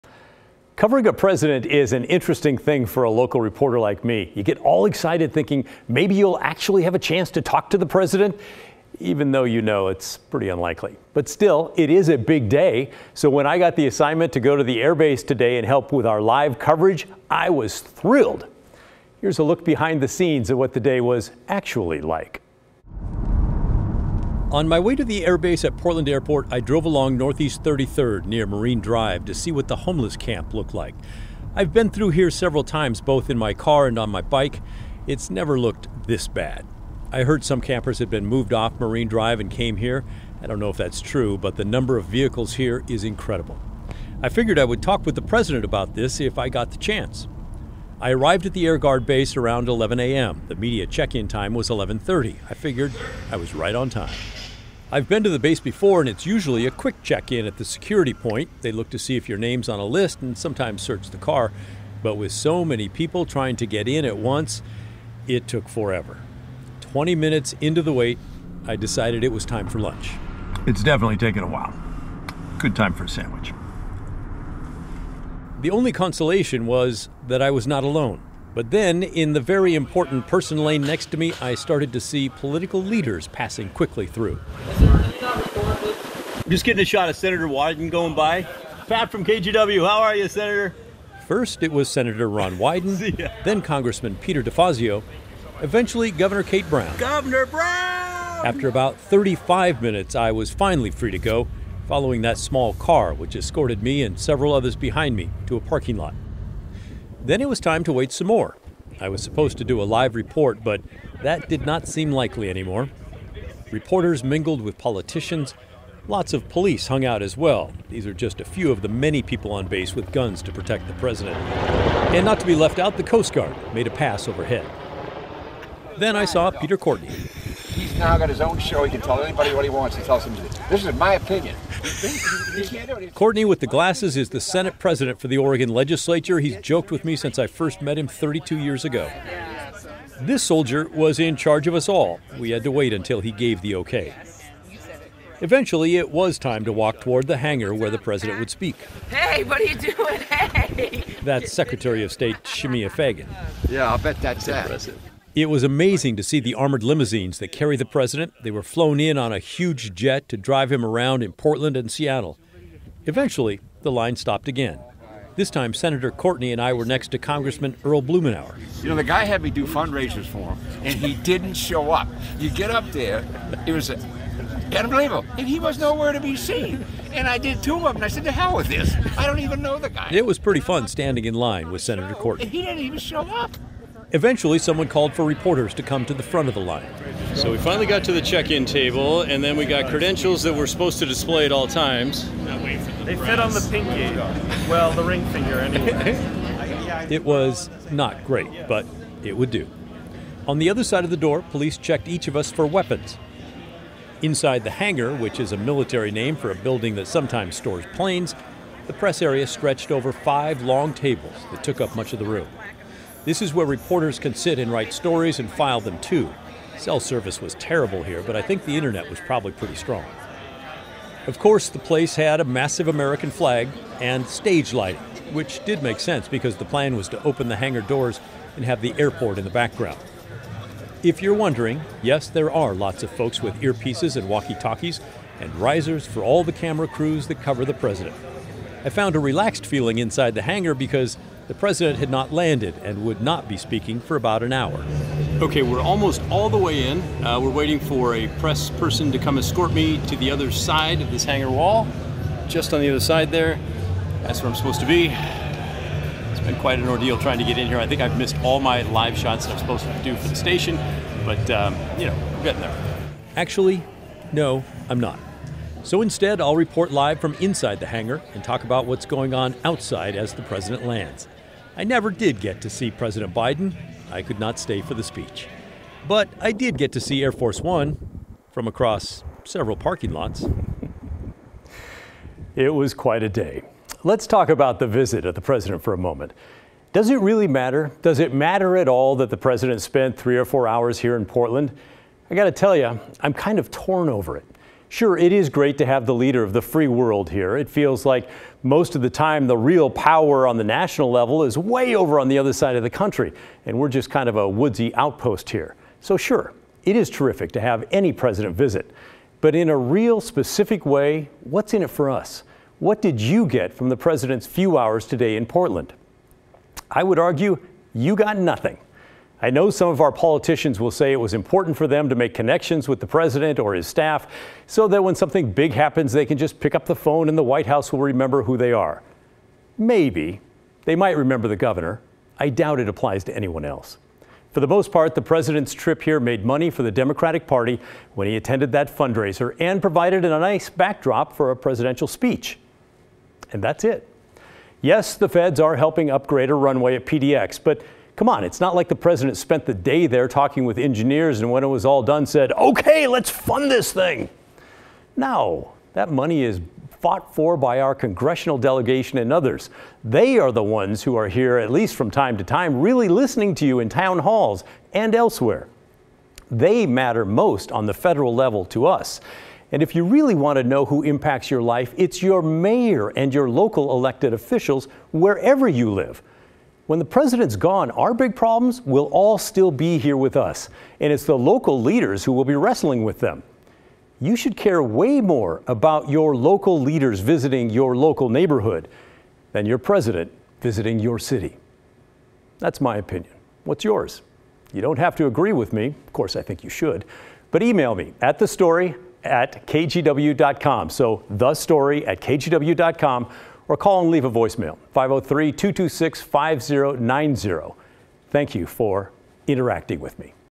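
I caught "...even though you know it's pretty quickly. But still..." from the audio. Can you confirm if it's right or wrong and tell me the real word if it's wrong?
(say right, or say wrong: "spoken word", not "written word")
wrong: "unlikely", not "quickly".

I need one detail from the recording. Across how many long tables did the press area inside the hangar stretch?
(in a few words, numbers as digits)
5.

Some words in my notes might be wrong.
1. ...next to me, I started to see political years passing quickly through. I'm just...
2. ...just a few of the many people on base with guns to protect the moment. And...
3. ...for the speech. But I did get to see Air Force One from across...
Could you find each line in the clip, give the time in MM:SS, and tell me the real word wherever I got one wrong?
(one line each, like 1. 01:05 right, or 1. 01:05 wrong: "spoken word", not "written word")
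1. 01:20 wrong: "leaders", not "years"
2. 01:58 wrong: "president", not "moment"
3. 04:34 right.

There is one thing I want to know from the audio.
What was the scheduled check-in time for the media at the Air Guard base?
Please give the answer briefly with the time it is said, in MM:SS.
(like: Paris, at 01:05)
11:30, at 00:51.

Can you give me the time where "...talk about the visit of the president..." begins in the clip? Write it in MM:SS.
04:44.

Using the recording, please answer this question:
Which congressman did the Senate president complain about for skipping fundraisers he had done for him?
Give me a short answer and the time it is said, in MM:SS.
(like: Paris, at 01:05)
Earl Blumenauer, at 02:47.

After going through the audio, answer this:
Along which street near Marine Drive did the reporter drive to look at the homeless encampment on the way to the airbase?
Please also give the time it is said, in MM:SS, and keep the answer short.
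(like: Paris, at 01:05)
Northeast 33rd, at 00:27.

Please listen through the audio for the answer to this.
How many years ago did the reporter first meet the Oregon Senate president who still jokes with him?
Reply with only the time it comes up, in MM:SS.
02:18.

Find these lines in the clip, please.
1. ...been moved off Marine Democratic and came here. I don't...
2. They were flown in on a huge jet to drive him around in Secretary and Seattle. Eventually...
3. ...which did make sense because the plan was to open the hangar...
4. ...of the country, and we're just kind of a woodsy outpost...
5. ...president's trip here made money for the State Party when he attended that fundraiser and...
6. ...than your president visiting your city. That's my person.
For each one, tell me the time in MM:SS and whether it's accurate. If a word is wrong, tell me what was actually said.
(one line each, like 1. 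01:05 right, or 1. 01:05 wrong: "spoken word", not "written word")
1. 00:38 wrong: "Drive", not "Democratic"
2. 02:38 wrong: "Portland", not "Secretary"
3. 03:45 right
4. 05:02 right
5. 05:35 wrong: "Democratic", not "State"
6. 06:29 wrong: "opinion", not "person".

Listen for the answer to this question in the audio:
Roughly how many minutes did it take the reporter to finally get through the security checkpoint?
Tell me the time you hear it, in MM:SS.
01:38.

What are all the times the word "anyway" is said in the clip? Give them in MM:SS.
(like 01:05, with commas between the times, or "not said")
03:15.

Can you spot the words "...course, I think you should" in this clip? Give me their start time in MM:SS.
06:36.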